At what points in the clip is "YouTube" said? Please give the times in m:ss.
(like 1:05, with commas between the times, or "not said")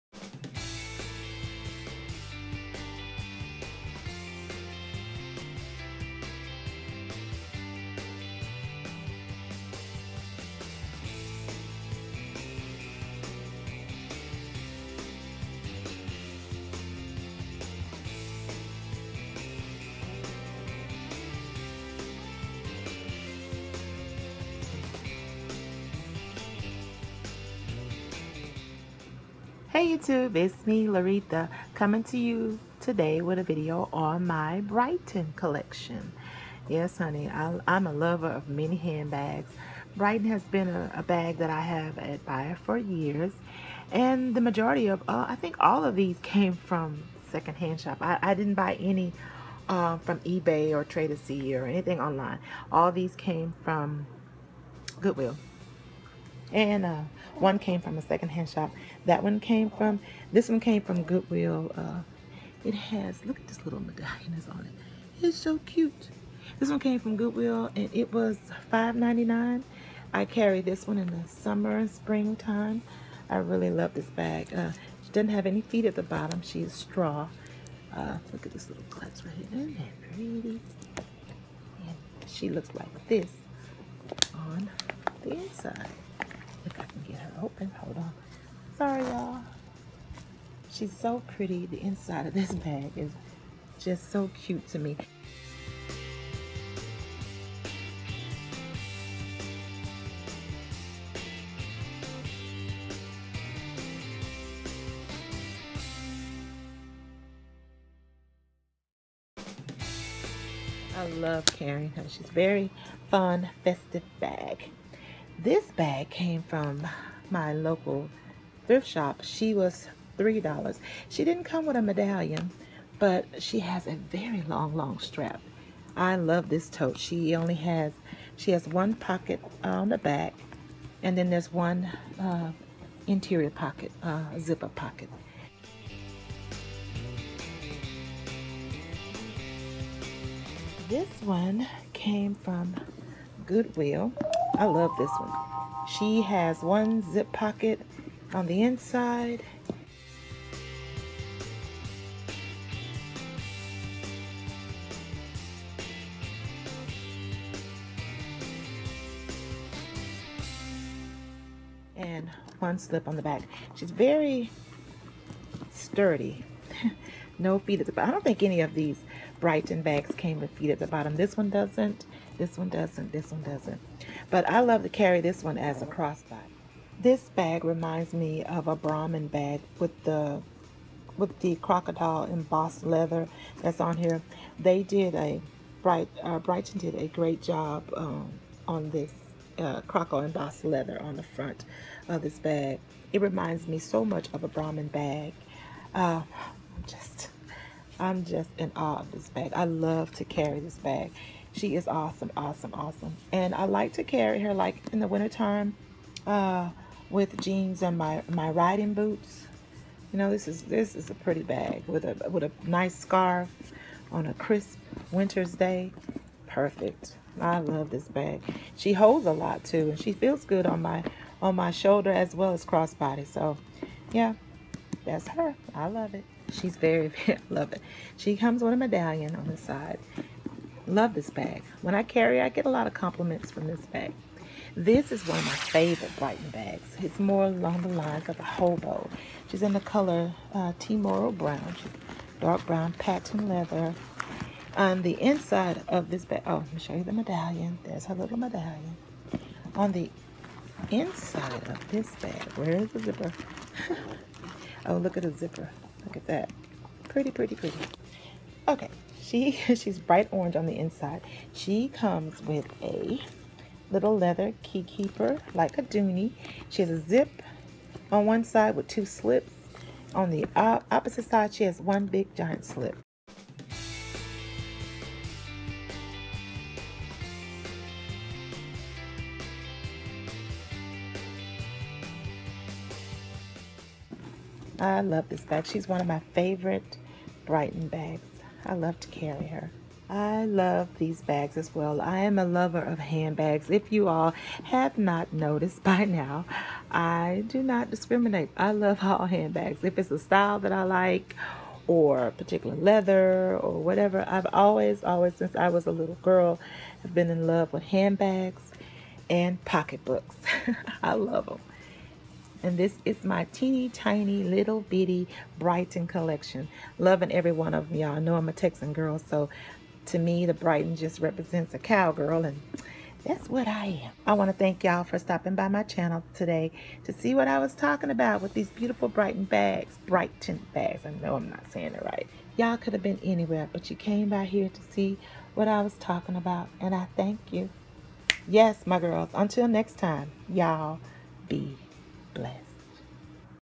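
0:29.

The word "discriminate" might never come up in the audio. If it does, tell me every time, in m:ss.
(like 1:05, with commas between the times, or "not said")
4:57.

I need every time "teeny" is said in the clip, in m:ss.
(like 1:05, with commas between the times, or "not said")
5:13.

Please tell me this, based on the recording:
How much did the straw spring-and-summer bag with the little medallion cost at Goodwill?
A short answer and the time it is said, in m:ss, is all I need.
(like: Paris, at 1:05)
$5.99, at 1:08.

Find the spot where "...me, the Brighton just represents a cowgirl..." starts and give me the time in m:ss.
5:20.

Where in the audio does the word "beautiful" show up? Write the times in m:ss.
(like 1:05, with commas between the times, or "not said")
5:28.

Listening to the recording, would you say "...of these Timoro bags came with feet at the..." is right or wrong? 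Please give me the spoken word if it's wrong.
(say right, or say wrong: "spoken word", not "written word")
wrong: "Brighton", not "Timoro".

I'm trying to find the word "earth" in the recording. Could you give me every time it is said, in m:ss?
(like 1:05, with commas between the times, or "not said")
not said.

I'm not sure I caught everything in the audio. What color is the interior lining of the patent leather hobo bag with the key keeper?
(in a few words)
Bright orange.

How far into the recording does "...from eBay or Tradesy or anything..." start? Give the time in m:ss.
0:49.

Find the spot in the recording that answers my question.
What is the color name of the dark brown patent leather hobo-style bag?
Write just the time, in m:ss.
4:00.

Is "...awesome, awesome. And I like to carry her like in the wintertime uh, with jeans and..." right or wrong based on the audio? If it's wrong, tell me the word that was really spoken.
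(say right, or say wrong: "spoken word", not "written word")
right.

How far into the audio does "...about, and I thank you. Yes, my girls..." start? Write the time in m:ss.
5:36.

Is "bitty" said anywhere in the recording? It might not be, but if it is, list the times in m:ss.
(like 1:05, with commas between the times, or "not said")
5:14.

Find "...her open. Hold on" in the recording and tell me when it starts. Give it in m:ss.
1:27.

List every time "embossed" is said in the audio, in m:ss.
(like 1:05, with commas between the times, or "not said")
3:02, 3:10.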